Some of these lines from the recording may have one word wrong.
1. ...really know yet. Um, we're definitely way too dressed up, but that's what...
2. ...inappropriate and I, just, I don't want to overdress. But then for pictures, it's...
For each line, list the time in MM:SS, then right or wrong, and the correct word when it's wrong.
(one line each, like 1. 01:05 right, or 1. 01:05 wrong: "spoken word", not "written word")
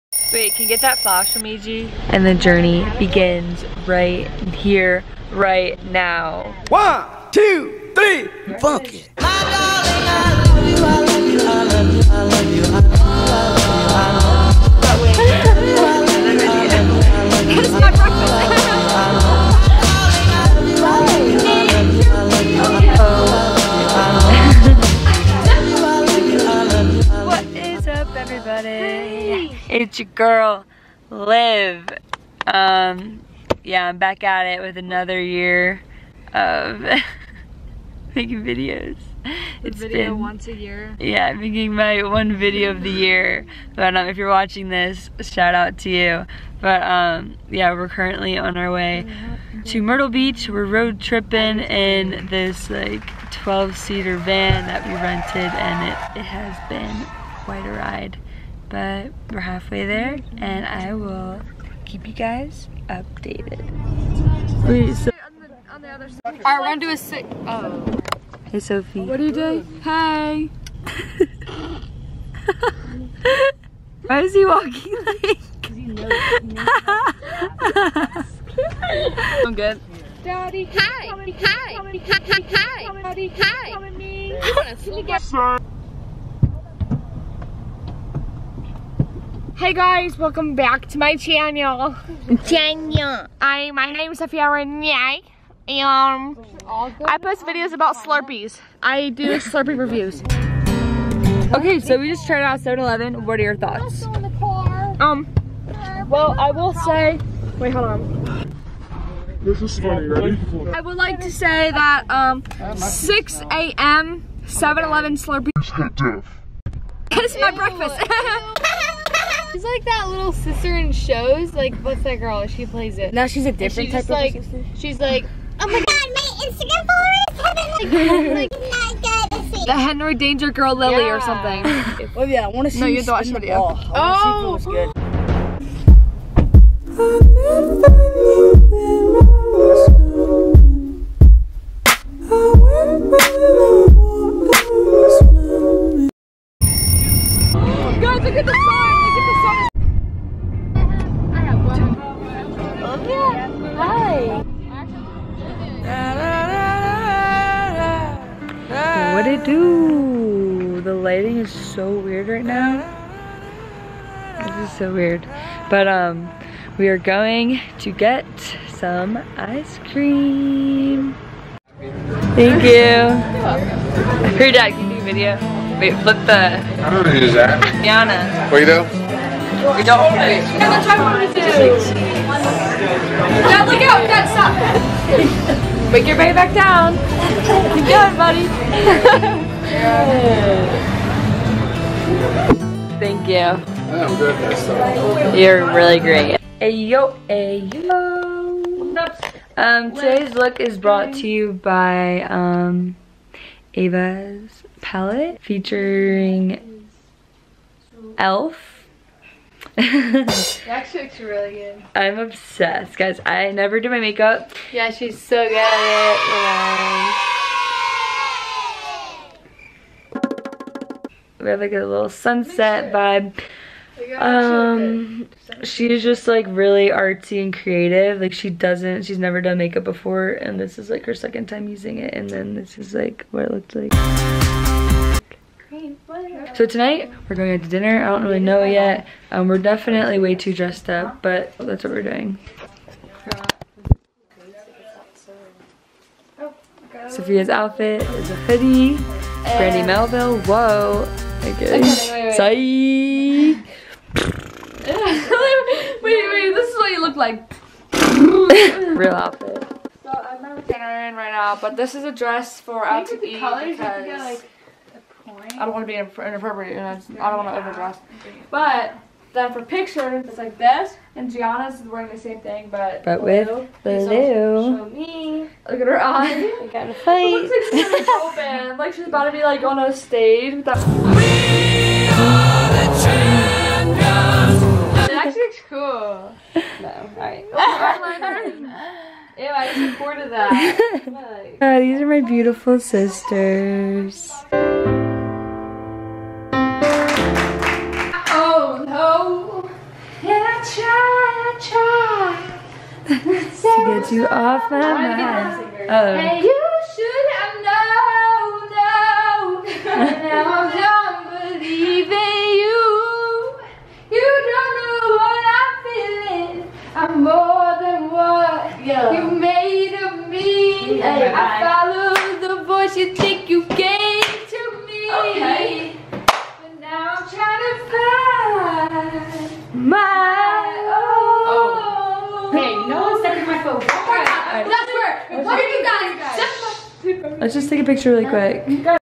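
1. 03:58 right
2. 04:25 right.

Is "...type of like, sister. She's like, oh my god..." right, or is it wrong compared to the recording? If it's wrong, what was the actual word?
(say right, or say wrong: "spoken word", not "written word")
right.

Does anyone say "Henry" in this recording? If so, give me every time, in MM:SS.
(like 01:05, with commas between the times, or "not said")
02:09.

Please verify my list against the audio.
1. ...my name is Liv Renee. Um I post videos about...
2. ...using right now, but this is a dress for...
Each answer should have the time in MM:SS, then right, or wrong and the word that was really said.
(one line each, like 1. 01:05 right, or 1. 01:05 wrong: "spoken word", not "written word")
1. 01:33 wrong: "Sophia", not "Liv"
2. 04:20 wrong: "wearing", not "using".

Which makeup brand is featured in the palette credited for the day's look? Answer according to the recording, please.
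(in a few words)
Elf.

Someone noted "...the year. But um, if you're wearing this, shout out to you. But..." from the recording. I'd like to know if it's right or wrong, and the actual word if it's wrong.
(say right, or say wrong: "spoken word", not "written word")
wrong: "watching", not "wearing".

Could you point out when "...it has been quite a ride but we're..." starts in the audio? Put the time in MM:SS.
00:56.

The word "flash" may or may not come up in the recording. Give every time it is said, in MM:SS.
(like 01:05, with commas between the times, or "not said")
00:00.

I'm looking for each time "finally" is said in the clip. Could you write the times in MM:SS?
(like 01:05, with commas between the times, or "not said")
not said.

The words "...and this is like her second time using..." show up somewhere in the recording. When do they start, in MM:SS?
03:50.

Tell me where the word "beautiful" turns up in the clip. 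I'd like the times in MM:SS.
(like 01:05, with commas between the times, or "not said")
04:52.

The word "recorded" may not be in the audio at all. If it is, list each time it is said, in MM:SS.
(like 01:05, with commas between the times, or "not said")
04:49.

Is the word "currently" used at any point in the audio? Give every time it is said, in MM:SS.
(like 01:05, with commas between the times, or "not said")
00:47.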